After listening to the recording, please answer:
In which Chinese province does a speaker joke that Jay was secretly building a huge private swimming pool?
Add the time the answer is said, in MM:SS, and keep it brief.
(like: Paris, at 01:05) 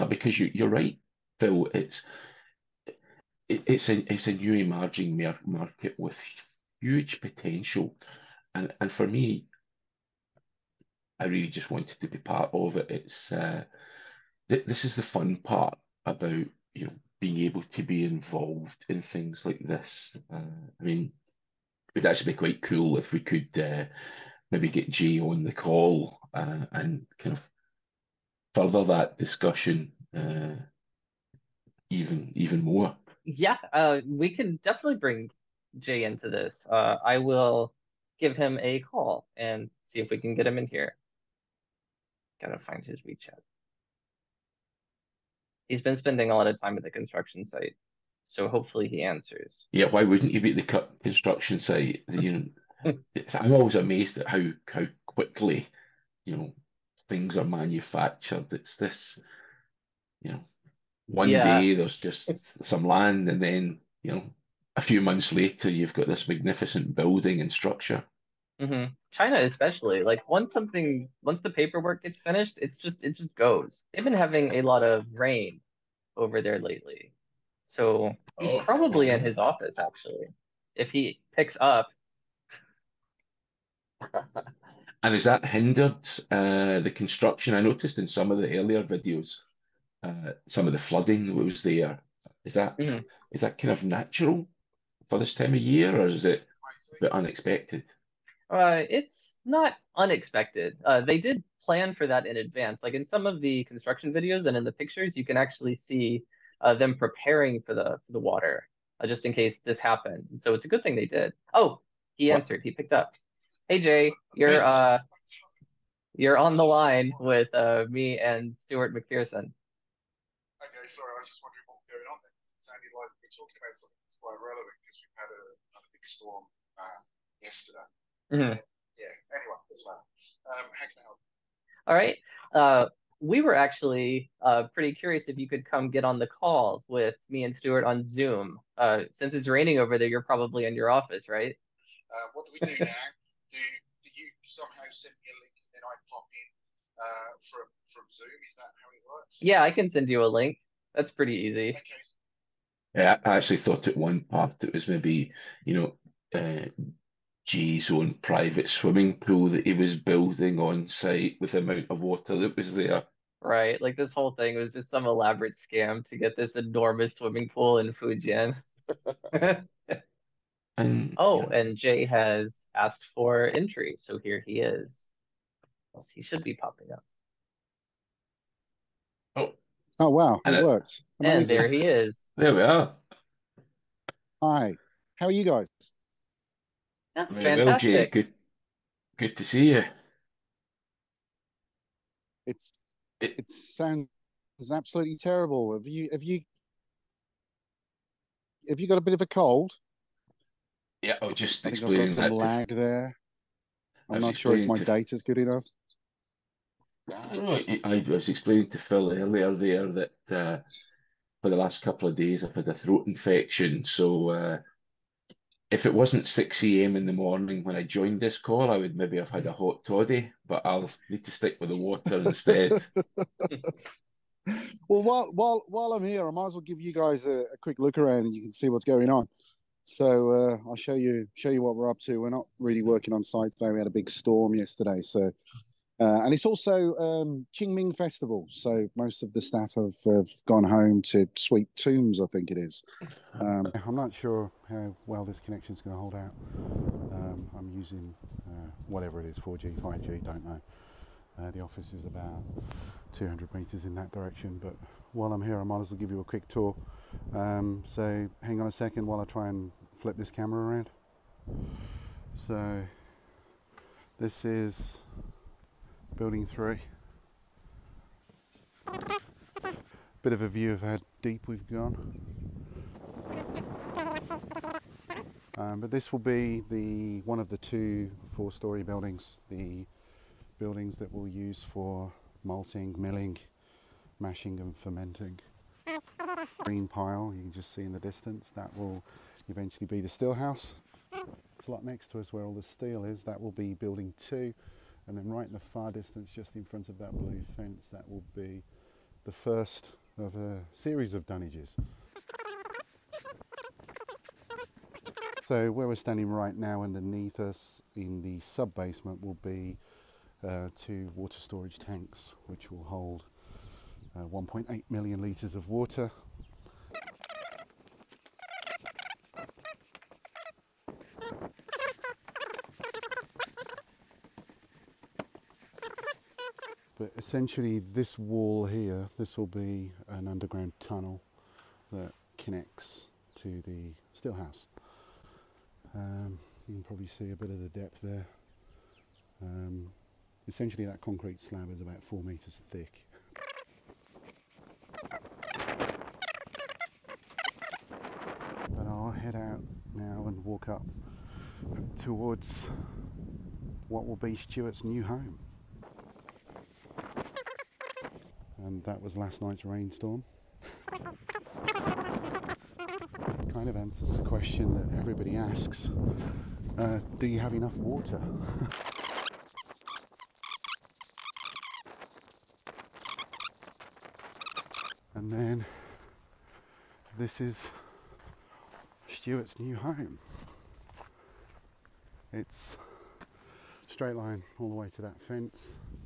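Fujian, at 02:47.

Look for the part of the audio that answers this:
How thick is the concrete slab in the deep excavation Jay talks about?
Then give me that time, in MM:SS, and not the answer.
05:42.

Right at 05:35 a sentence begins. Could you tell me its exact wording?
Um, you can probably see a bit of the depth there.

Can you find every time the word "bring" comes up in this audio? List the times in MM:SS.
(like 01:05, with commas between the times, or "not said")
00:34.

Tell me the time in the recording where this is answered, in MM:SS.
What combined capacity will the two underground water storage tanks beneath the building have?
05:14.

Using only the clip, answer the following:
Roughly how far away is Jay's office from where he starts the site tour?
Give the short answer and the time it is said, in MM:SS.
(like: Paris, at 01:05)
200 meters, at 04:13.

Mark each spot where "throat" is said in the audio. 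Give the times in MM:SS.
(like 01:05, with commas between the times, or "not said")
03:32.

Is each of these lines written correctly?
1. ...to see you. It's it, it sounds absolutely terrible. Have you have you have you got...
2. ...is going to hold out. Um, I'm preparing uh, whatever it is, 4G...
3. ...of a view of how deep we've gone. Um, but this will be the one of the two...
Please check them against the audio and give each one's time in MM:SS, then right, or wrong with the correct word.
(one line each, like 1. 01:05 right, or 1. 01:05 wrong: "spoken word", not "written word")
1. 03:09 right
2. 04:05 wrong: "using", not "preparing"
3. 04:30 right.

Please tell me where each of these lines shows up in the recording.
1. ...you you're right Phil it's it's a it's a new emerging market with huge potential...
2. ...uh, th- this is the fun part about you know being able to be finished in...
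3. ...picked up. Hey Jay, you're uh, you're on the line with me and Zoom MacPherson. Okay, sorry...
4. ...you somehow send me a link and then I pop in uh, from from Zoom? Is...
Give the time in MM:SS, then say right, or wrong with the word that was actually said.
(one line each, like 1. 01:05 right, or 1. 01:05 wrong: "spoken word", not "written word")
1. 00:00 right
2. 00:13 wrong: "involved", not "finished"
3. 01:52 wrong: "Stuart", not "Zoom"
4. 02:24 right.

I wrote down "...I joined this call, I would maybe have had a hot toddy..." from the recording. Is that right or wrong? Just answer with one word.
right.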